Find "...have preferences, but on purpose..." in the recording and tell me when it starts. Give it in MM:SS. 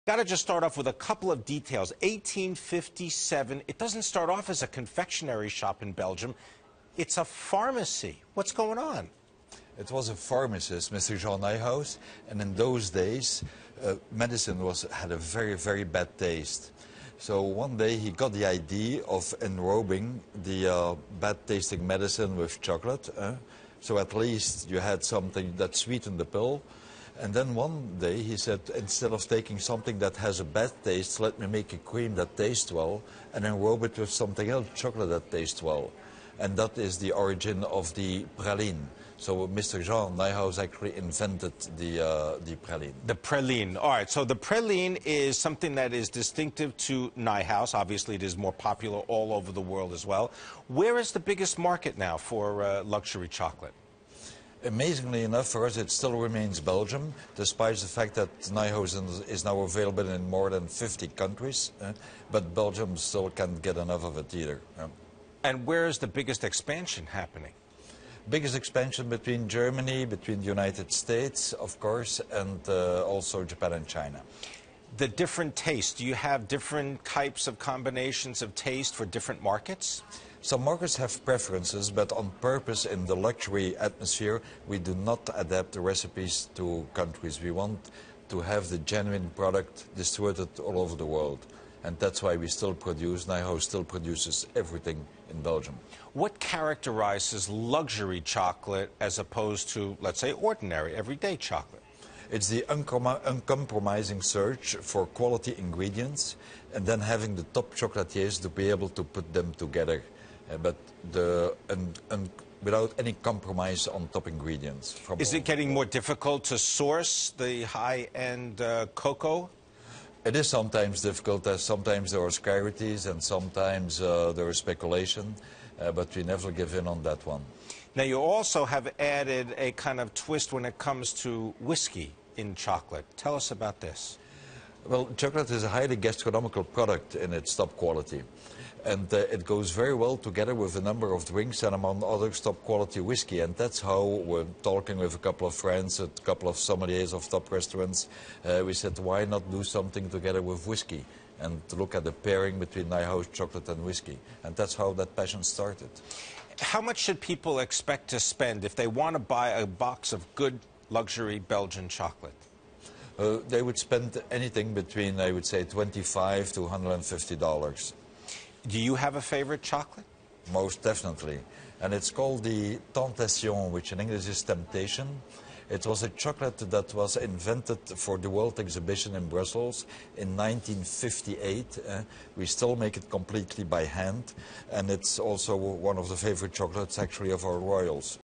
01:20.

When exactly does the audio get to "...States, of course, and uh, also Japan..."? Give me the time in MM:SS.
01:10.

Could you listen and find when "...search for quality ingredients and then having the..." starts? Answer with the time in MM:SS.
01:44.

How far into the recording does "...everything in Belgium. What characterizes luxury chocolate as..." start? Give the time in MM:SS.
01:34.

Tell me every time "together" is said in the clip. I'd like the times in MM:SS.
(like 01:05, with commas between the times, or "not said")
01:49, 02:20, 02:30.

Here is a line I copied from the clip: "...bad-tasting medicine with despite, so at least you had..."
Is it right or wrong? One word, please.
wrong.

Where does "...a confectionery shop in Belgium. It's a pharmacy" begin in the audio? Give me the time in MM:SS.
00:04.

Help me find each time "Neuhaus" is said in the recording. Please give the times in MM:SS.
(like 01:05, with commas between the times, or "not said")
00:11, 00:40, 00:47, 01:33, 02:32.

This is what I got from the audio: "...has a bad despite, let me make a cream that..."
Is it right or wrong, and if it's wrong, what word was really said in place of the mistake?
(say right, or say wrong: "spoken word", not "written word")
wrong: "taste", not "despite".